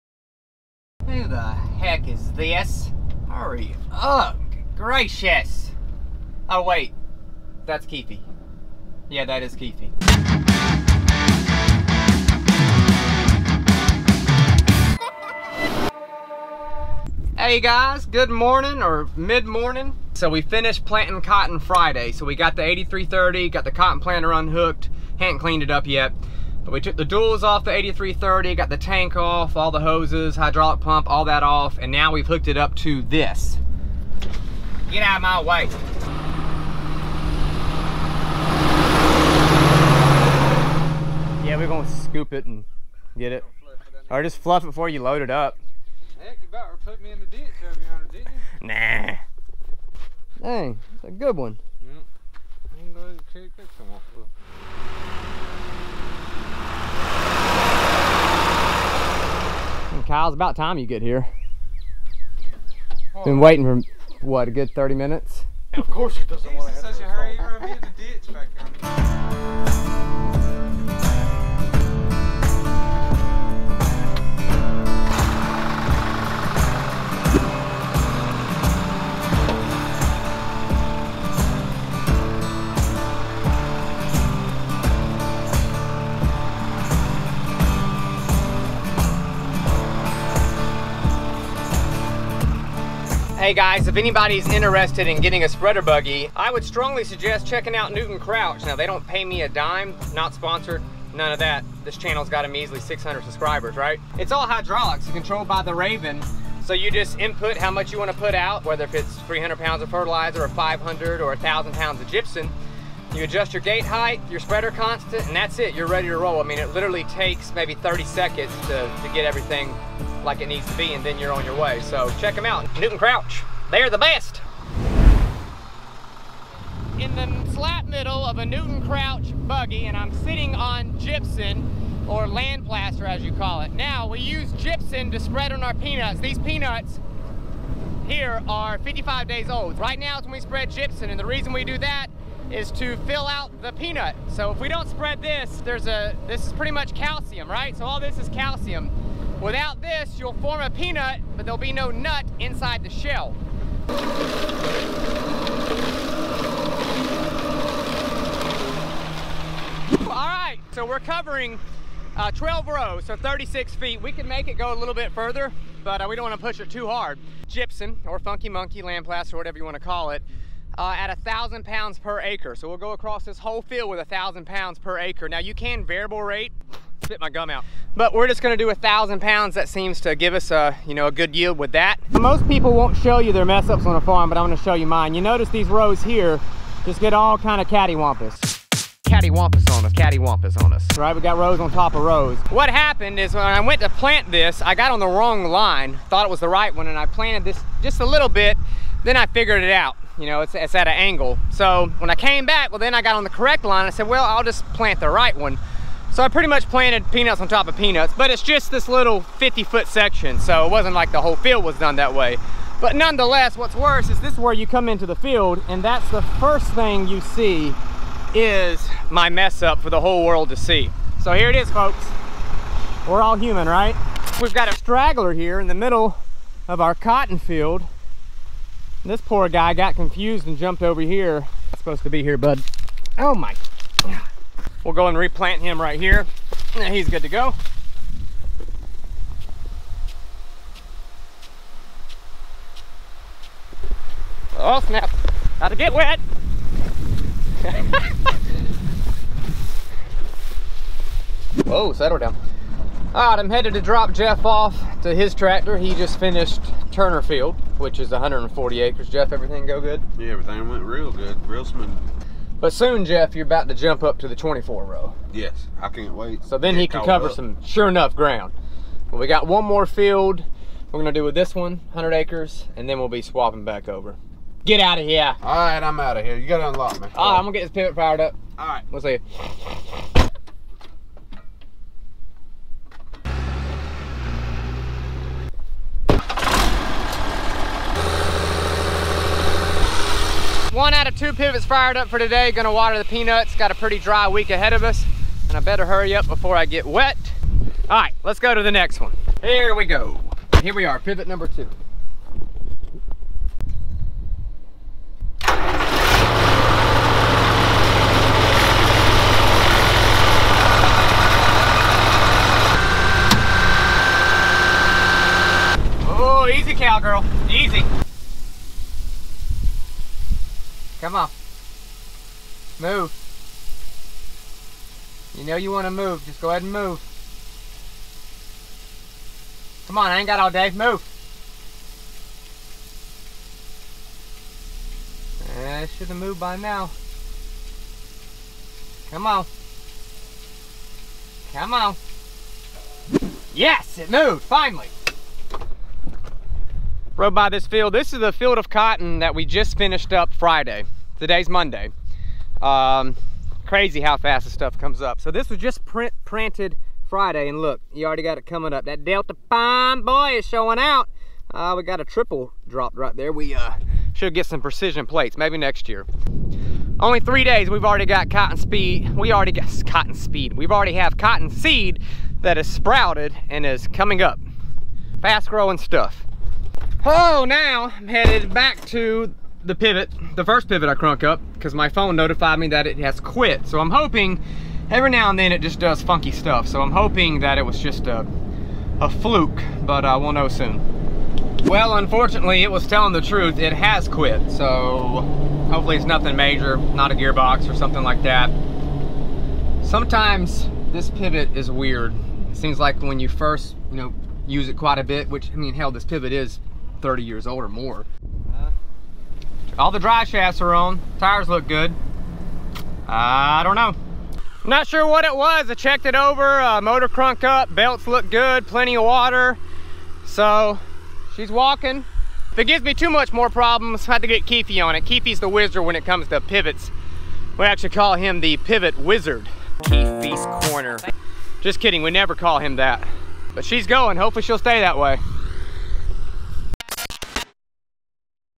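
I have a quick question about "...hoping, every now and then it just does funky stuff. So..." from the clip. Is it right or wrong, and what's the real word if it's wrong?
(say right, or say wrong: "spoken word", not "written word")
right.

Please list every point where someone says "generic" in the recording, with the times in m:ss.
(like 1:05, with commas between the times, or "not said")
not said.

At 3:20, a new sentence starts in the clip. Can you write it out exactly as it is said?
You know, it's, it's at an angle.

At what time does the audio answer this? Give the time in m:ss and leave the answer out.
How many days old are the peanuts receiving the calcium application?
2:18.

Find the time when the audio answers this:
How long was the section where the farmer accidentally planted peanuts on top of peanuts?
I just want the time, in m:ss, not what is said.
3:29.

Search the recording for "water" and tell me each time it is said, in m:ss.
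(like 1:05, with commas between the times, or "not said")
4:52, 6:59.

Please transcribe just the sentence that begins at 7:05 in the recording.
Keefe's the wizard when it comes to pivots.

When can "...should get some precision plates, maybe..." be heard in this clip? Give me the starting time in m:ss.
6:04.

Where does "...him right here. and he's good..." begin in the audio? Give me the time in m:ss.
3:55.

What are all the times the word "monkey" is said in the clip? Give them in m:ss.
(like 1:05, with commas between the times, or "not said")
2:48.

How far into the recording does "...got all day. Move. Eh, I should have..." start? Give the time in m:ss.
5:30.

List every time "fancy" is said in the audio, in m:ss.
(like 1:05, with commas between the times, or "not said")
not said.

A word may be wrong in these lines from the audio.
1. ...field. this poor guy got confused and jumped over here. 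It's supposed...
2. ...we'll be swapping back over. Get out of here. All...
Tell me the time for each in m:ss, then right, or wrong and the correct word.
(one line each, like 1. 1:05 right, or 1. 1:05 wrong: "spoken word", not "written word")
1. 3:47 right
2. 4:32 right.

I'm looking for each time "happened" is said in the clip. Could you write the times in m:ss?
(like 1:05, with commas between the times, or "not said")
3:12.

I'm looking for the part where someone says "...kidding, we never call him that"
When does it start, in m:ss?
7:11.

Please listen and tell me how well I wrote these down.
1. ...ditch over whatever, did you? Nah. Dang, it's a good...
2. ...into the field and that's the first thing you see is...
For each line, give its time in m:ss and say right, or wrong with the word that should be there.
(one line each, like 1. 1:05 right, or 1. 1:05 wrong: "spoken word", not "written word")
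1. 0:47 wrong: "yonder", not "whatever"
2. 3:34 right.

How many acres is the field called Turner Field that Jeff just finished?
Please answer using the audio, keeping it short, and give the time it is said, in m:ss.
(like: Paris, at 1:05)
140, at 4:18.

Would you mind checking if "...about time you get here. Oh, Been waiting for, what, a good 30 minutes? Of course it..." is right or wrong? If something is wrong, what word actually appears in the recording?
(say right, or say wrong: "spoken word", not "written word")
right.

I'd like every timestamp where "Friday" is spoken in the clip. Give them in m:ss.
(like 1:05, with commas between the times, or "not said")
0:21, 5:50, 5:56.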